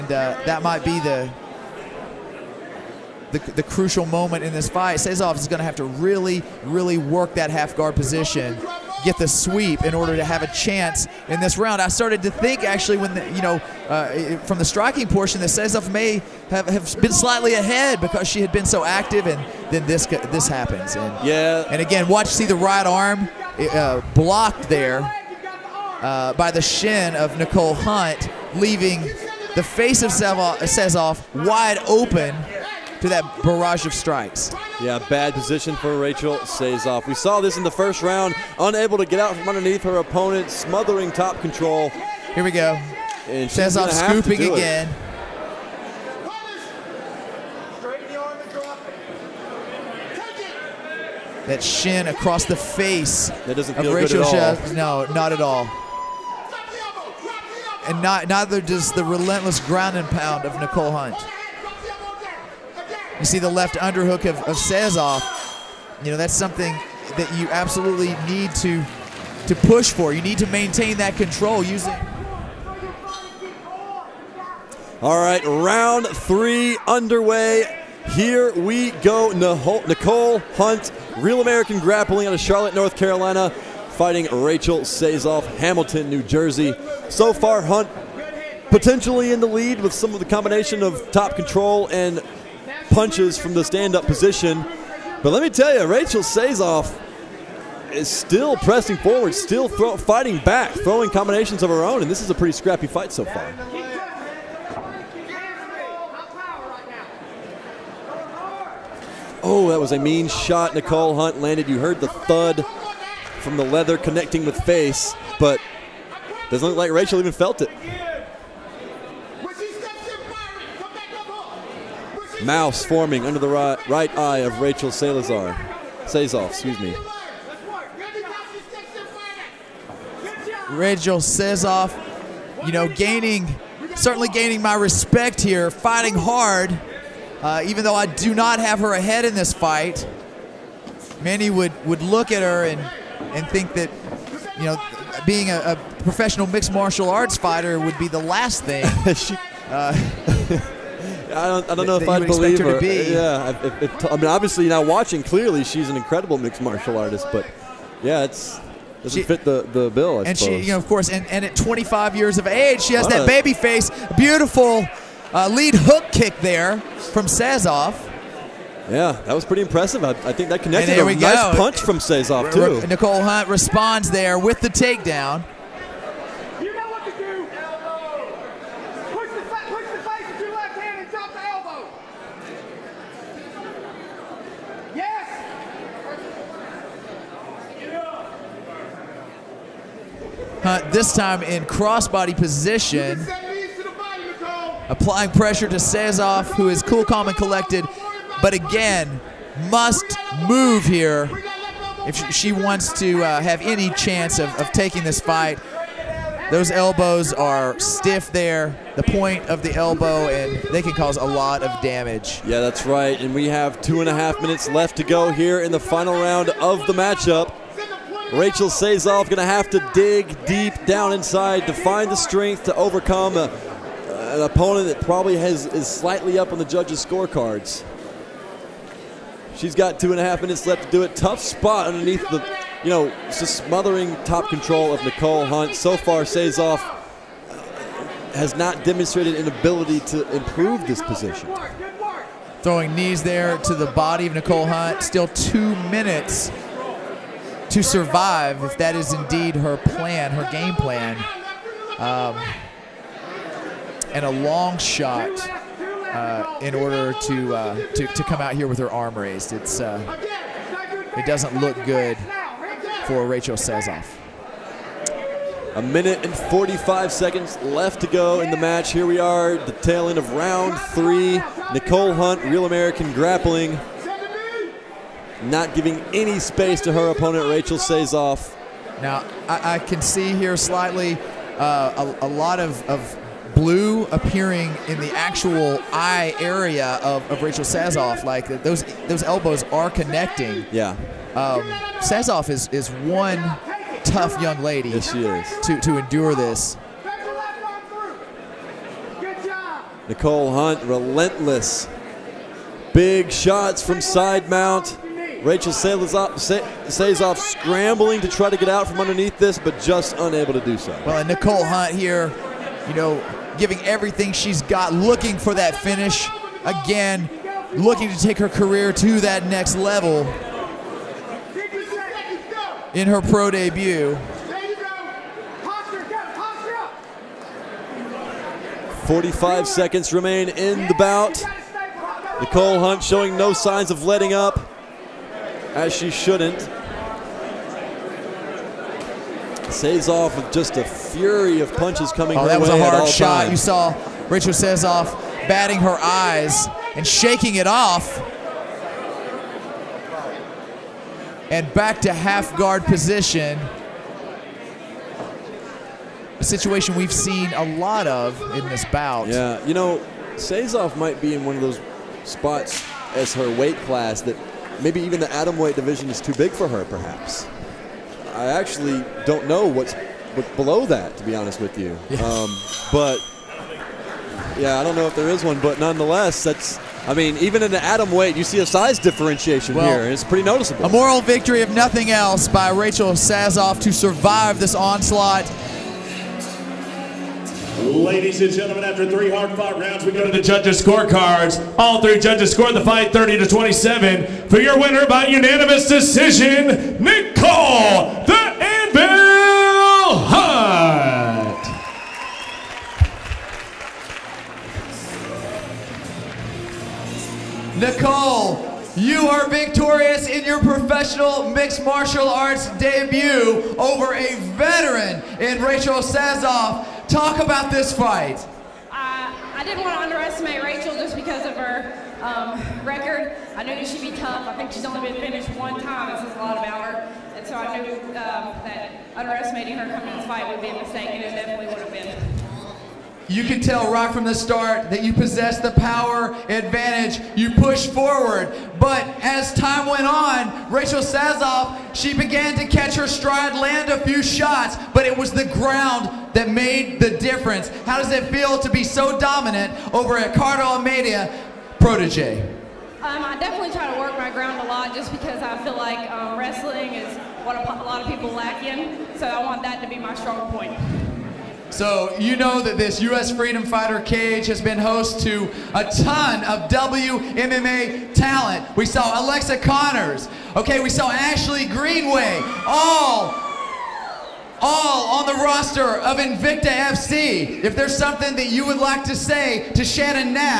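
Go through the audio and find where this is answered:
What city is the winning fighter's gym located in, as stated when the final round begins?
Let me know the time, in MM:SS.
01:22.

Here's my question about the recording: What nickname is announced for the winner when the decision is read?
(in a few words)
The Anvil.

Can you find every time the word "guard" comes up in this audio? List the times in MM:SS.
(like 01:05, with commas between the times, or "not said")
00:07, 05:52.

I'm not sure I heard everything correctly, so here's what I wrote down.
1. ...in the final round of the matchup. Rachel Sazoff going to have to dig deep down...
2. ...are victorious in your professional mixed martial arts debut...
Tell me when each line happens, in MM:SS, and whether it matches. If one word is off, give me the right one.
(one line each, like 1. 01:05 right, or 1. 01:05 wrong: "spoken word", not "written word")
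1. 03:35 right
2. 06:49 right.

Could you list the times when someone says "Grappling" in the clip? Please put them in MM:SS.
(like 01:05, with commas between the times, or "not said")
01:21, 04:33.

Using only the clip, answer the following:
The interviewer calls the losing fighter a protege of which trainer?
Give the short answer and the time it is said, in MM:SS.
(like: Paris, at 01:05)
Ricardo Almeida, at 07:30.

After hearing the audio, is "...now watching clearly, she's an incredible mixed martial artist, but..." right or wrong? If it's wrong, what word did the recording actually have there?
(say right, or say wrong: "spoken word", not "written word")
right.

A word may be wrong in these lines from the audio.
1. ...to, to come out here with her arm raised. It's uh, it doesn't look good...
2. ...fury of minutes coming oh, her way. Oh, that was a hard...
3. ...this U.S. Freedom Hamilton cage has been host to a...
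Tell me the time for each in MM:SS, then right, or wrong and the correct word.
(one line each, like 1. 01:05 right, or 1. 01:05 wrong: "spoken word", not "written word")
1. 04:17 right
2. 05:40 wrong: "punches", not "minutes"
3. 07:42 wrong: "Fighter", not "Hamilton".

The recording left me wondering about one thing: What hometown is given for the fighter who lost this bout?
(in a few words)
Hamilton, New Jersey.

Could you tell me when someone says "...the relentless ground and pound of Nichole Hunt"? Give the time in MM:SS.
00:58.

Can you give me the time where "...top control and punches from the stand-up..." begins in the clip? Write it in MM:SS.
01:31.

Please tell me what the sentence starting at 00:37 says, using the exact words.
We saw this in the first round, unable to get out from underneath her opponent, smothering top control.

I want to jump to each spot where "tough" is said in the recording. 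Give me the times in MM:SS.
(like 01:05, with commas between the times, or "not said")
03:51, 04:54, 07:04.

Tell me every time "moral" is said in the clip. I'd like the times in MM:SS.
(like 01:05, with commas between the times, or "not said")
06:20.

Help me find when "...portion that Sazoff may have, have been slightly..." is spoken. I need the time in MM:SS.
00:15.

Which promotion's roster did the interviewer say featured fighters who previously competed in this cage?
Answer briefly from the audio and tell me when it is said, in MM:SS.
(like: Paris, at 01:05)
Invicta FC, at 07:56.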